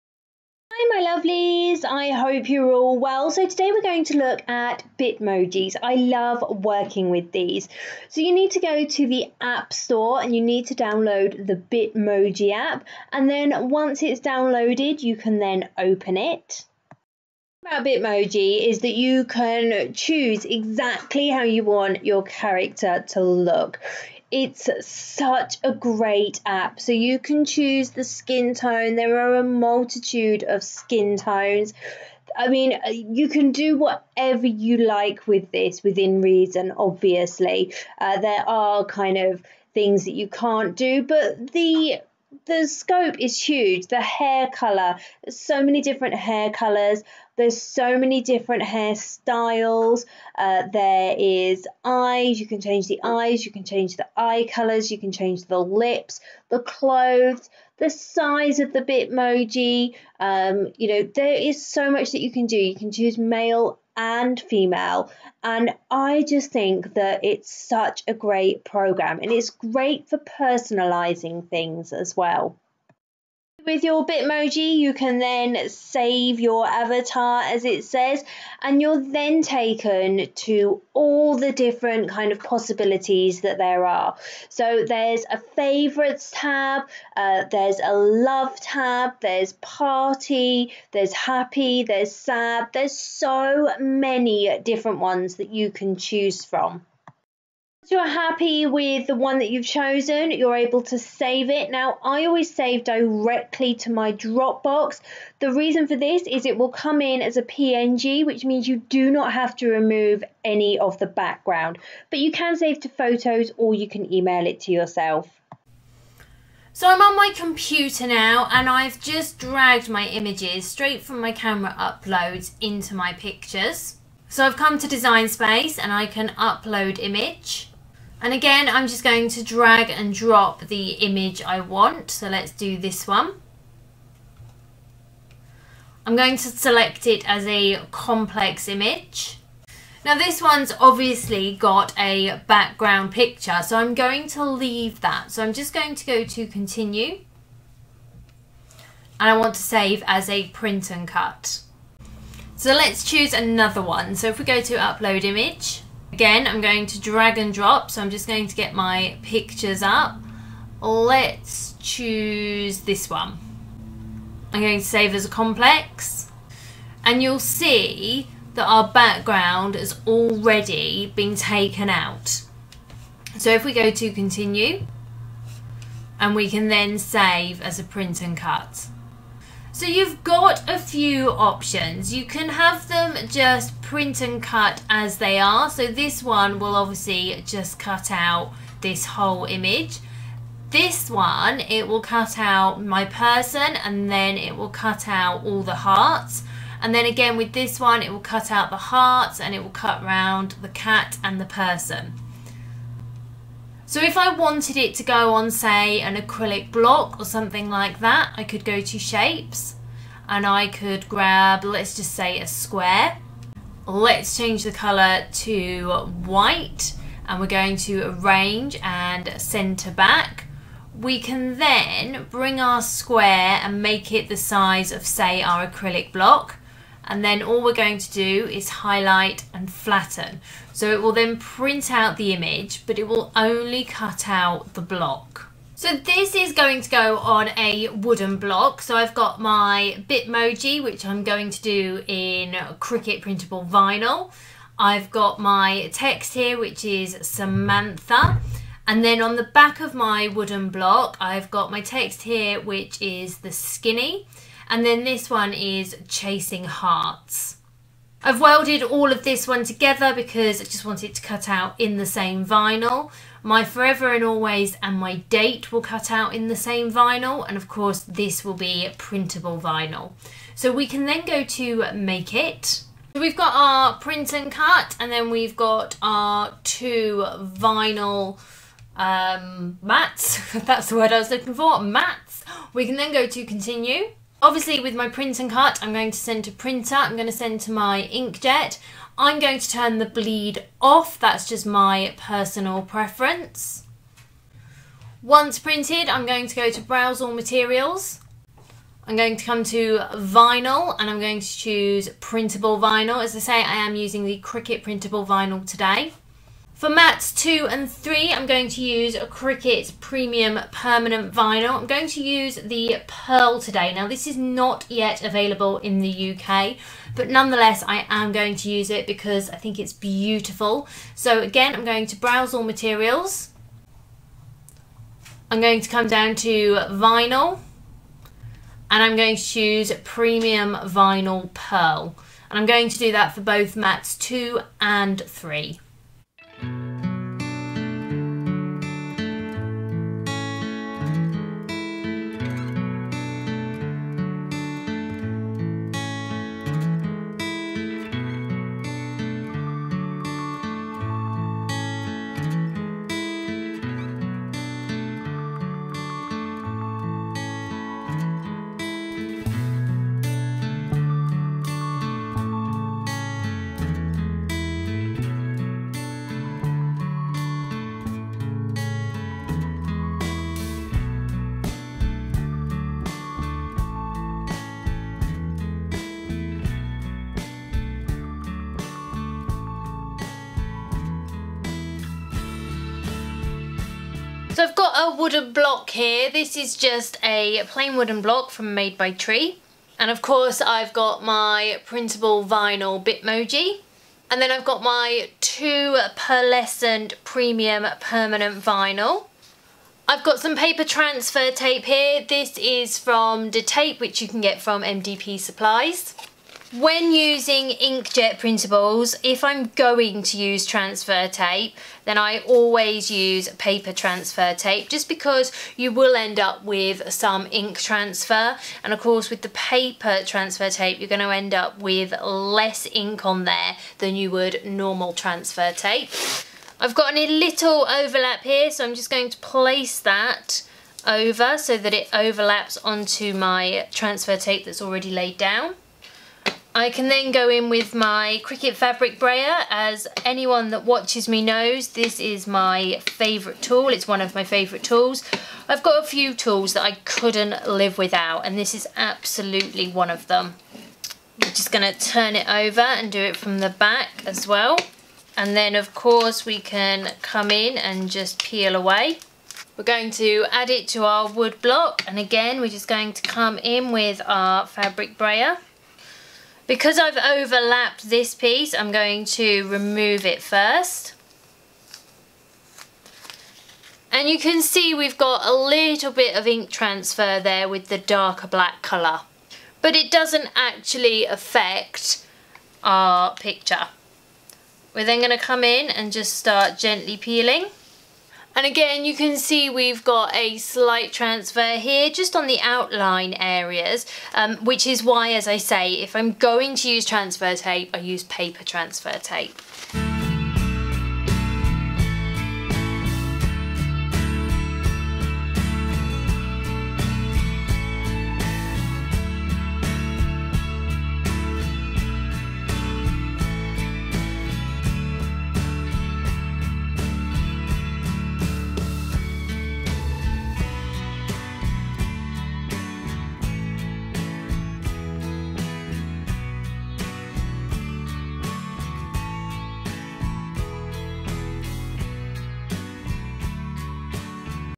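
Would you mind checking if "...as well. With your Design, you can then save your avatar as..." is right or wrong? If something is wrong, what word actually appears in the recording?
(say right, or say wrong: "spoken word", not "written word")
wrong: "Bitmoji", not "Design".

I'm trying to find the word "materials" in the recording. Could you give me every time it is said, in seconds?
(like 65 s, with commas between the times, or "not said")
297 s, 322 s.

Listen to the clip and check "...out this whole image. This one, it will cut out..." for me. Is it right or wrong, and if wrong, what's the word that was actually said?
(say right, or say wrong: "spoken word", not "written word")
right.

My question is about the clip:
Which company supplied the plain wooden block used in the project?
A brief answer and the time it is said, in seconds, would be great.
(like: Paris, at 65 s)
Made by Tree, at 388 s.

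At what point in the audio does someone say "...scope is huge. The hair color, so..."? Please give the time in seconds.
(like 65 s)
42 s.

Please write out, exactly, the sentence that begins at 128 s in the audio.
And again, I'm just going to drag and drop the image I want.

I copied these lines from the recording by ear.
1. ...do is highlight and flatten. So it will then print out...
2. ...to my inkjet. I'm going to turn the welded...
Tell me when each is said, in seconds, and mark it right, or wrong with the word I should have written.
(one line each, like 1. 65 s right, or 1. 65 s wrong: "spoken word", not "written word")
1. 228 s right
2. 287 s wrong: "bleed", not "welded".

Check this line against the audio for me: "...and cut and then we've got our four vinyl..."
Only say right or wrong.
wrong.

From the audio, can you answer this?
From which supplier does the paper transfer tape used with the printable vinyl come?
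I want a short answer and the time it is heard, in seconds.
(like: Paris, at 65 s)
MDP Supplies, at 404 s.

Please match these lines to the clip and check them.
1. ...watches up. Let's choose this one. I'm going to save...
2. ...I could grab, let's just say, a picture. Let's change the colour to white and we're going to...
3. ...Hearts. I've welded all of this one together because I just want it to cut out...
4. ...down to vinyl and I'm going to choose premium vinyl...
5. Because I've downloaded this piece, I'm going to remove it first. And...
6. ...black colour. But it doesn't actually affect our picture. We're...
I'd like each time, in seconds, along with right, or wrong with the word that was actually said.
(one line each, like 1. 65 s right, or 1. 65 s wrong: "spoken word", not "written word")
1. 159 s wrong: "pictures", not "watches"
2. 210 s wrong: "square", not "picture"
3. 256 s right
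4. 326 s right
5. 466 s wrong: "overlapped", not "downloaded"
6. 478 s right.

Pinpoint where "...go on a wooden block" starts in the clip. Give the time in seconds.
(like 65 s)
236 s.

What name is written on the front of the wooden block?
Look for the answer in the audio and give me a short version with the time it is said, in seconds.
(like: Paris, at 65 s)
Samantha, at 247 s.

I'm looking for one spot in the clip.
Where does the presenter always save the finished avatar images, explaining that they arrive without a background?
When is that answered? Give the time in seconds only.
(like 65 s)
103 s.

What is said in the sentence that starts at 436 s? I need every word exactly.
I can then go in with my Cricut Fabric Brayer.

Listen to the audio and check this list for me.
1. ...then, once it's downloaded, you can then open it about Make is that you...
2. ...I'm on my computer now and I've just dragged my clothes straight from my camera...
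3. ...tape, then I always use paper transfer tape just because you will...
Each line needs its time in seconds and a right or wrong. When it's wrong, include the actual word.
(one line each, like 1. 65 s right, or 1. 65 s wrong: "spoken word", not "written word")
1. 13 s wrong: "Bitmoji", not "Make"
2. 116 s wrong: "images", not "clothes"
3. 411 s right.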